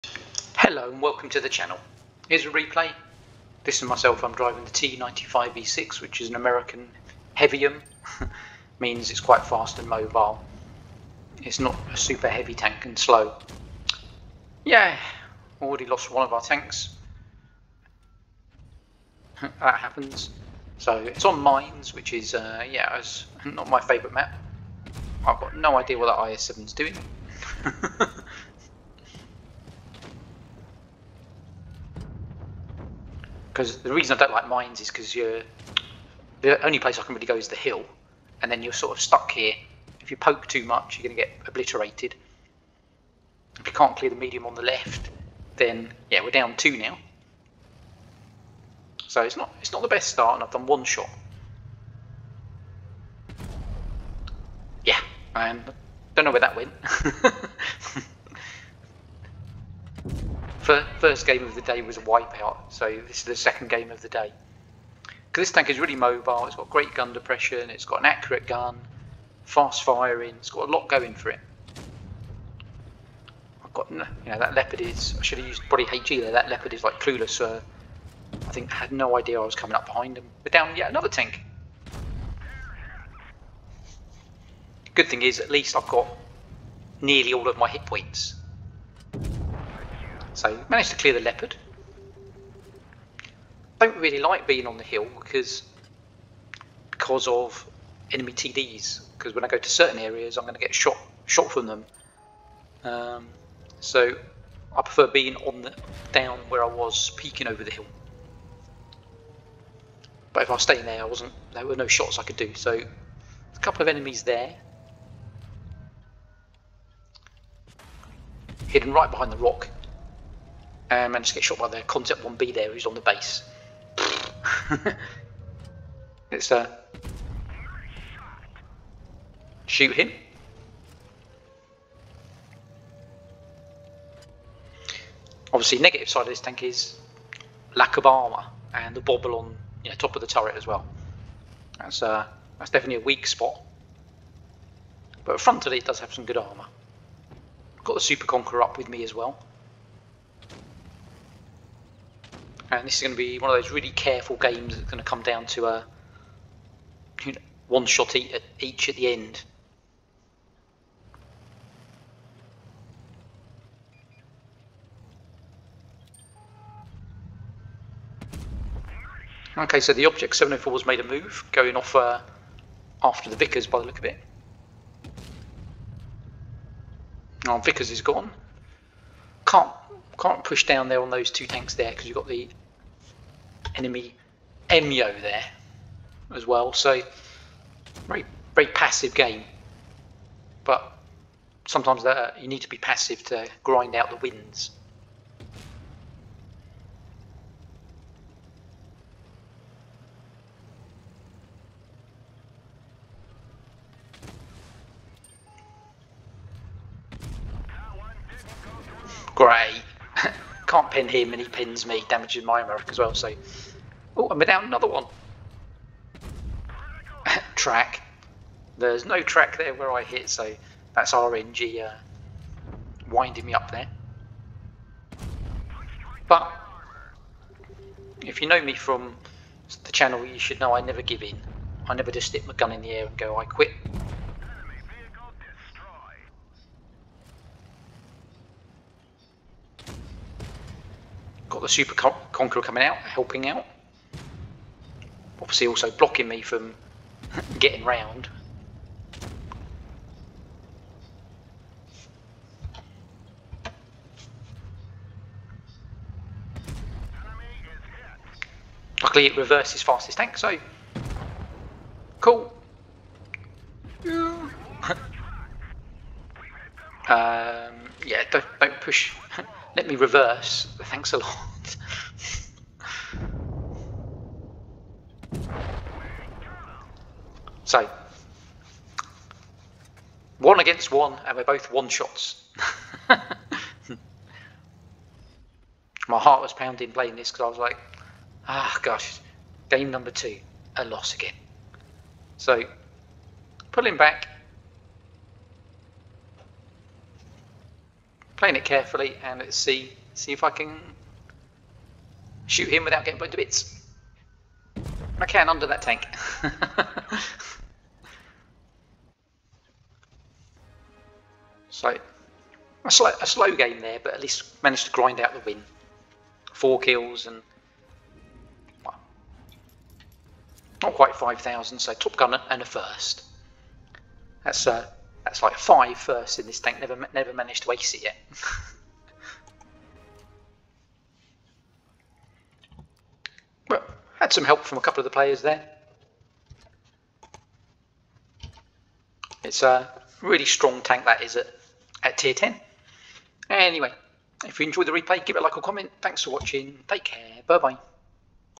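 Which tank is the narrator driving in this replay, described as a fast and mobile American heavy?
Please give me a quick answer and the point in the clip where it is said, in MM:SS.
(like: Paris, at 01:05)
T95E6, at 00:04.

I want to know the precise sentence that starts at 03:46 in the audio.
But if you know me from the channel, you should know I never give in.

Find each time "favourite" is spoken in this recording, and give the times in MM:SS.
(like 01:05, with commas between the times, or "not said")
00:23.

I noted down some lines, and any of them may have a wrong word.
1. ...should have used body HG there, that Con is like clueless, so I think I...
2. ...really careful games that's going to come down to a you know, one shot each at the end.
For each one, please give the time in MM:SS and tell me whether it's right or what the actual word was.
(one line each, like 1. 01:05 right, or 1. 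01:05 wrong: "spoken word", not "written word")
1. 01:15 wrong: "Leopard", not "Con"
2. 02:33 right.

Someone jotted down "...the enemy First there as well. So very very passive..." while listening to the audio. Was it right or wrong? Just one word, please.
wrong.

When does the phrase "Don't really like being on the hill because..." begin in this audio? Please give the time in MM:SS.
01:33.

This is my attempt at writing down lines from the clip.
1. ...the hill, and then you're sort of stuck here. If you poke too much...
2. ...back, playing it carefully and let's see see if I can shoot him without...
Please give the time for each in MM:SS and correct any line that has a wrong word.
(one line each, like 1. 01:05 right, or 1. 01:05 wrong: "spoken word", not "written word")
1. 00:37 right
2. 04:53 right.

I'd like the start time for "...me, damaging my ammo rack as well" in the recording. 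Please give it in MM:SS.
03:31.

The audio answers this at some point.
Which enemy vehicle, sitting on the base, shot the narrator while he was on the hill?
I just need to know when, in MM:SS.
02:01.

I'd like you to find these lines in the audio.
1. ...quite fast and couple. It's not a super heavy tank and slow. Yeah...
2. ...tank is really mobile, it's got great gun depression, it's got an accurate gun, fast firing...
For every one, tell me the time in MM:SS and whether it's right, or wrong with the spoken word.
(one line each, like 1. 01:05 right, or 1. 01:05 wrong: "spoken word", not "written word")
1. 00:09 wrong: "mobile", not "couple"
2. 01:05 right.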